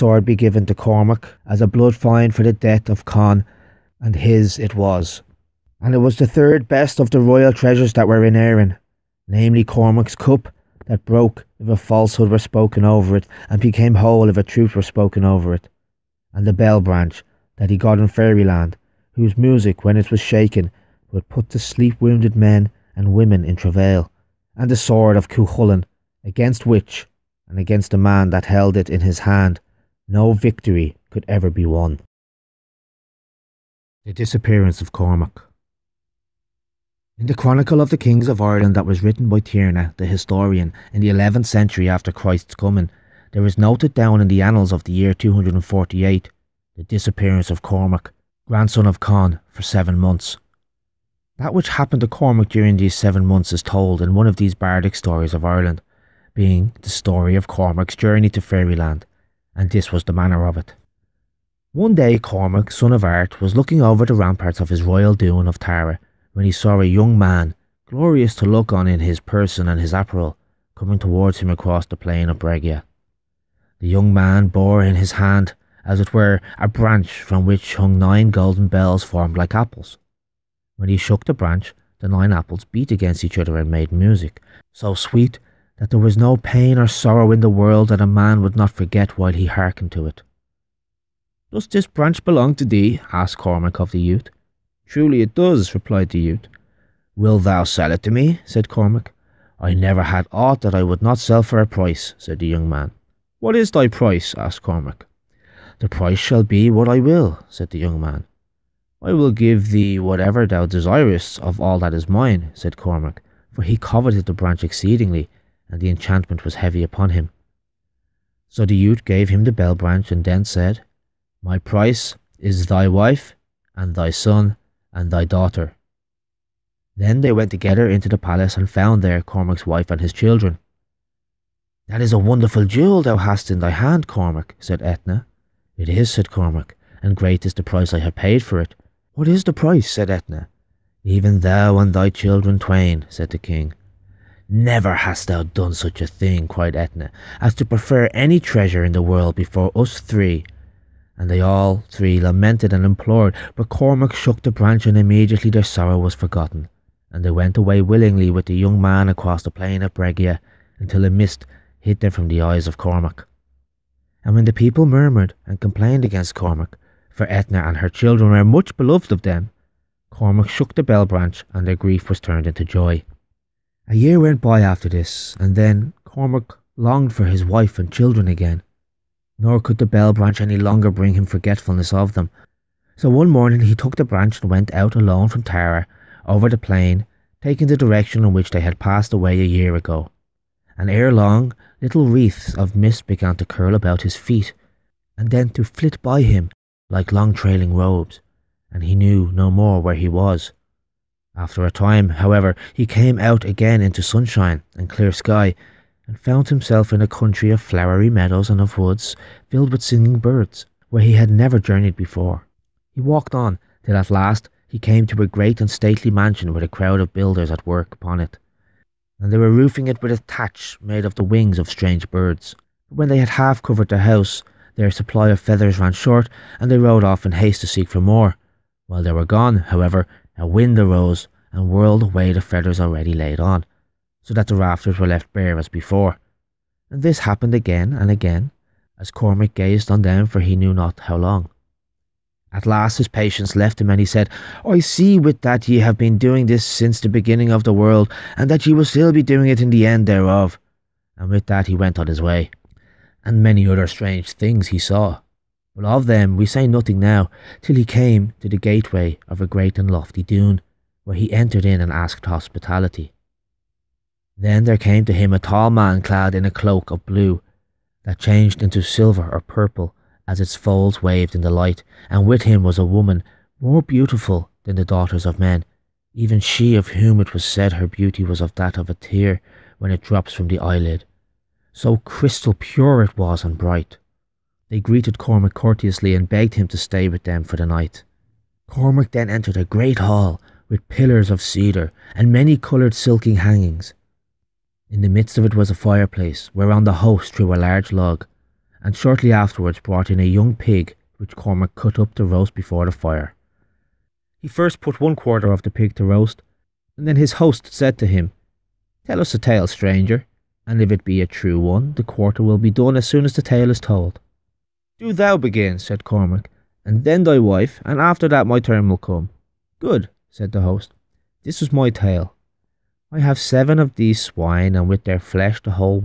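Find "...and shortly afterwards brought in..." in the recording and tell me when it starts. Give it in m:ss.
4:58.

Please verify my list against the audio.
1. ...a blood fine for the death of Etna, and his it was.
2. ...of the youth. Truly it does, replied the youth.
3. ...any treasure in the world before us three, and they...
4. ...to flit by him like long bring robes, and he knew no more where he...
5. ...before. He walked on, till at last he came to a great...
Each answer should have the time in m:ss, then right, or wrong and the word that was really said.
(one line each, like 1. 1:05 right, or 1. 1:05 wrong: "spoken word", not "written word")
1. 0:01 wrong: "Con", not "Etna"
2. 1:33 right
3. 2:28 right
4. 3:15 wrong: "trailing", not "bring"
5. 3:31 right.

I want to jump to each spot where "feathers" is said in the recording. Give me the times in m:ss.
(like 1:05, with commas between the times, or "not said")
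3:45, 3:52.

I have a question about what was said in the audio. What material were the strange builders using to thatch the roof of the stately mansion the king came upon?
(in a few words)
wings of strange birds.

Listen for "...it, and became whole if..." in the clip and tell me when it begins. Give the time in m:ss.
0:13.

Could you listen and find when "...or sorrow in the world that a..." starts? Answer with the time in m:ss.
1:26.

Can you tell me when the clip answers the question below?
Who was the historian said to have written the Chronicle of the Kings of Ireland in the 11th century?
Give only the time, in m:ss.
0:39.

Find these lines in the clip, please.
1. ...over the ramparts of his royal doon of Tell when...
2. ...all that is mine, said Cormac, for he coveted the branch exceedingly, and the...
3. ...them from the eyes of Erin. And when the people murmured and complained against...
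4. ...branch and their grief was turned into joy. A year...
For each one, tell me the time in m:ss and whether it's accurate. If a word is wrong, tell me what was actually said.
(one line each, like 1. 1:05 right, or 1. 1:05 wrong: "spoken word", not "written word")
1. 1:03 wrong: "Tara", not "Tell"
2. 1:51 right
3. 2:42 wrong: "Cormac", not "Erin"
4. 2:51 right.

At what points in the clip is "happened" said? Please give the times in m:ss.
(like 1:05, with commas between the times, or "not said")
0:51, 3:57.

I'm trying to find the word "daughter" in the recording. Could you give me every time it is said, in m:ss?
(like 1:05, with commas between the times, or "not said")
2:05, 4:34.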